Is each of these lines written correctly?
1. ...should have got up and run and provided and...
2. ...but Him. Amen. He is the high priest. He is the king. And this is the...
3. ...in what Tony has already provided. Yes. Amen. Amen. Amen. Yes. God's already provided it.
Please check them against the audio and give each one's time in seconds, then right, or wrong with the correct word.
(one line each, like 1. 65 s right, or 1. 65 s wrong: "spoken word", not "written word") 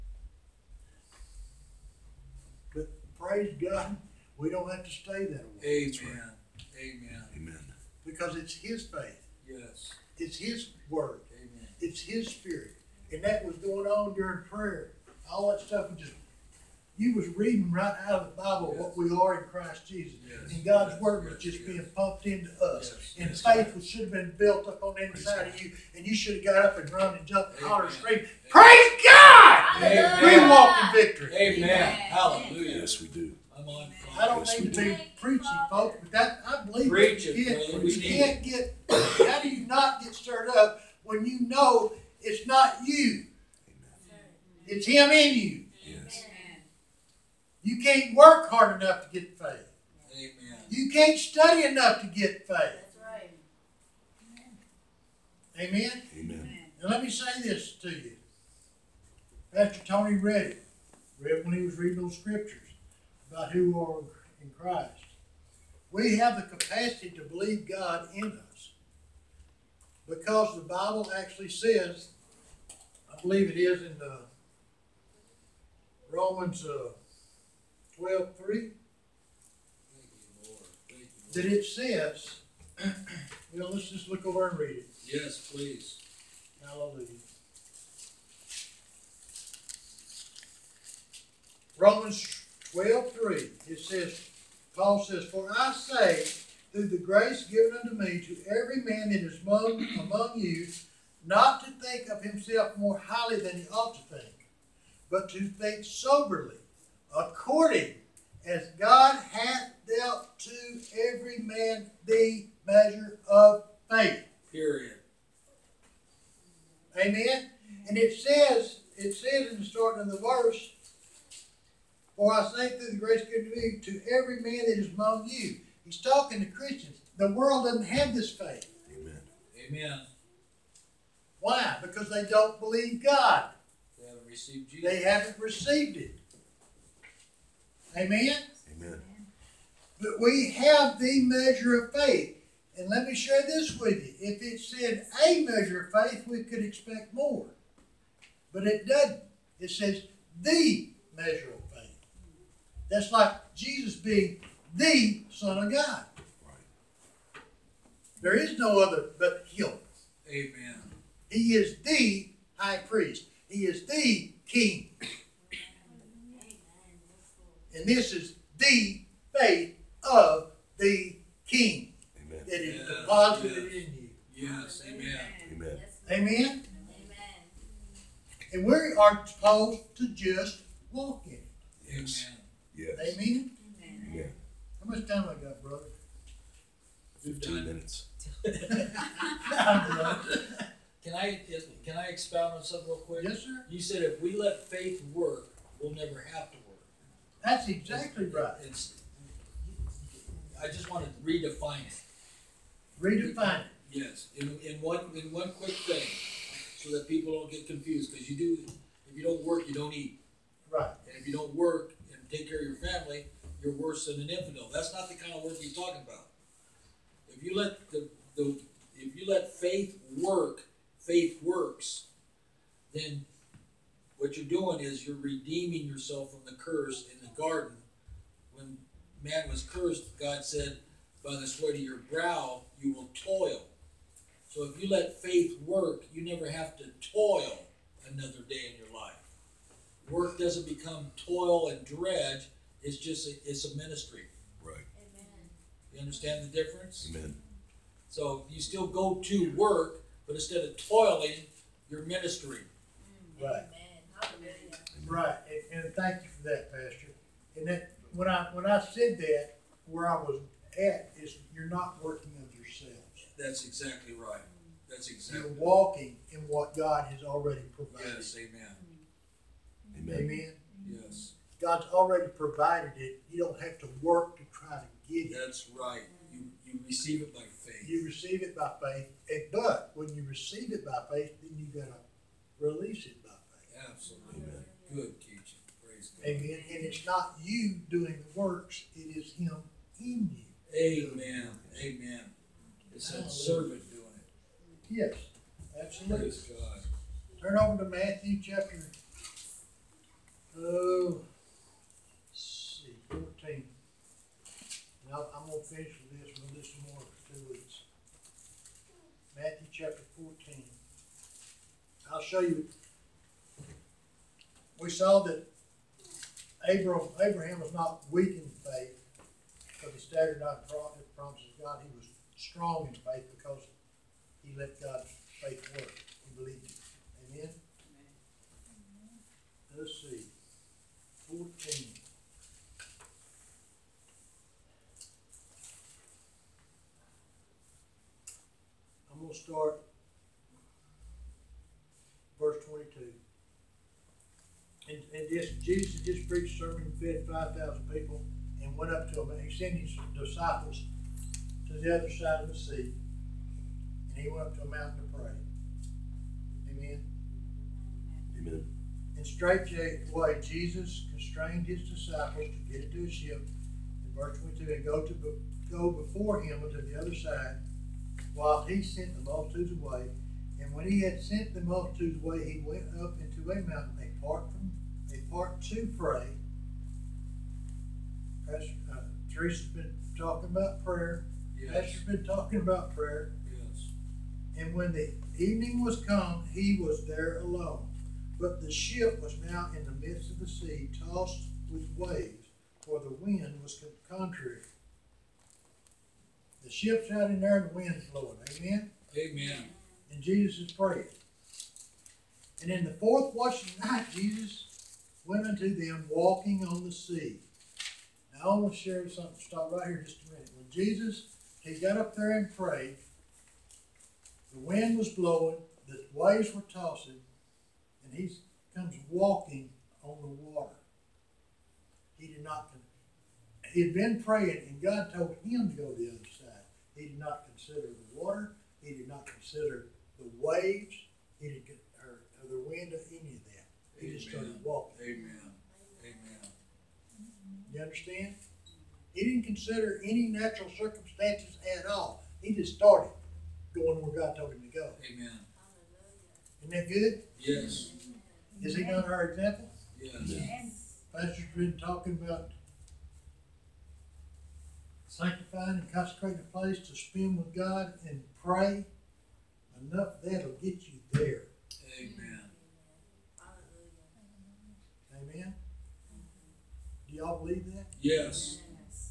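1. 26 s wrong: "jumped", not "provided"
2. 159 s right
3. 266 s wrong: "God", not "Tony".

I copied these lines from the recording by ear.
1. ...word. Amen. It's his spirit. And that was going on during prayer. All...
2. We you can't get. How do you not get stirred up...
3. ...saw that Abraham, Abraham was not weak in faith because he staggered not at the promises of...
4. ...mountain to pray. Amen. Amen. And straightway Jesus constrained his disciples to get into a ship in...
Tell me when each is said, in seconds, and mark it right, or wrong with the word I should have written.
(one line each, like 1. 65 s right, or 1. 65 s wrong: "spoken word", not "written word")
1. 10 s right
2. 37 s right
3. 314 s right
4. 354 s right.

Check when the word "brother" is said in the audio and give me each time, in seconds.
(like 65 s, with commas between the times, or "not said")
185 s.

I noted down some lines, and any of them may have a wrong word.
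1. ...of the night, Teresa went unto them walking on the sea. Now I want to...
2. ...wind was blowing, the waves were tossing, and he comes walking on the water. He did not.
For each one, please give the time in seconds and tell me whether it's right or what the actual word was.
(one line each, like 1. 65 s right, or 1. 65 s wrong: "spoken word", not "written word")
1. 403 s wrong: "Jesus", not "Teresa"
2. 414 s right.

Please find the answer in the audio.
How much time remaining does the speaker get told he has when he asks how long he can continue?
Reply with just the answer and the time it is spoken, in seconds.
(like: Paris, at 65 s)
15 minutes, at 187 s.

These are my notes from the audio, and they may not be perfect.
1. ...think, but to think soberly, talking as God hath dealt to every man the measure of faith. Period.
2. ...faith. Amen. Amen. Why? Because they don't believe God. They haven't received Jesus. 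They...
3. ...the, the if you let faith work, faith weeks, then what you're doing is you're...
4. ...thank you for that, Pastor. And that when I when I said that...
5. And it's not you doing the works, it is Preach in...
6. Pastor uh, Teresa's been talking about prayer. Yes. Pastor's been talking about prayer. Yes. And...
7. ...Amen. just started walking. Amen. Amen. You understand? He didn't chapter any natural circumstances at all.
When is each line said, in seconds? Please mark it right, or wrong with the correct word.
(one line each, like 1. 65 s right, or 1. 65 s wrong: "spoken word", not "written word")
1. 104 s wrong: "according", not "talking"
2. 128 s right
3. 217 s wrong: "works", not "weeks"
4. 255 s right
5. 286 s wrong: "Him", not "Preach"
6. 378 s right
7. 434 s wrong: "consider", not "chapter".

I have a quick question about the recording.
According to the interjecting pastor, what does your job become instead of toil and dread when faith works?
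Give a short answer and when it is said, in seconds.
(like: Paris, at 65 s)
a ministry, at 243 s.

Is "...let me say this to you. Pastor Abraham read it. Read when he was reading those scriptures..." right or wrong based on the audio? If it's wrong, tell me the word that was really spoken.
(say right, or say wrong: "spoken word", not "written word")
wrong: "Tony", not "Abraham".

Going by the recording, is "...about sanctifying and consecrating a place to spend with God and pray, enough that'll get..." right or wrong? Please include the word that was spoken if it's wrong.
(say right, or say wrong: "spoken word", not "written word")
right.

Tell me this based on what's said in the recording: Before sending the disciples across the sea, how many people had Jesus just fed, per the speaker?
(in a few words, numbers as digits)
5,000.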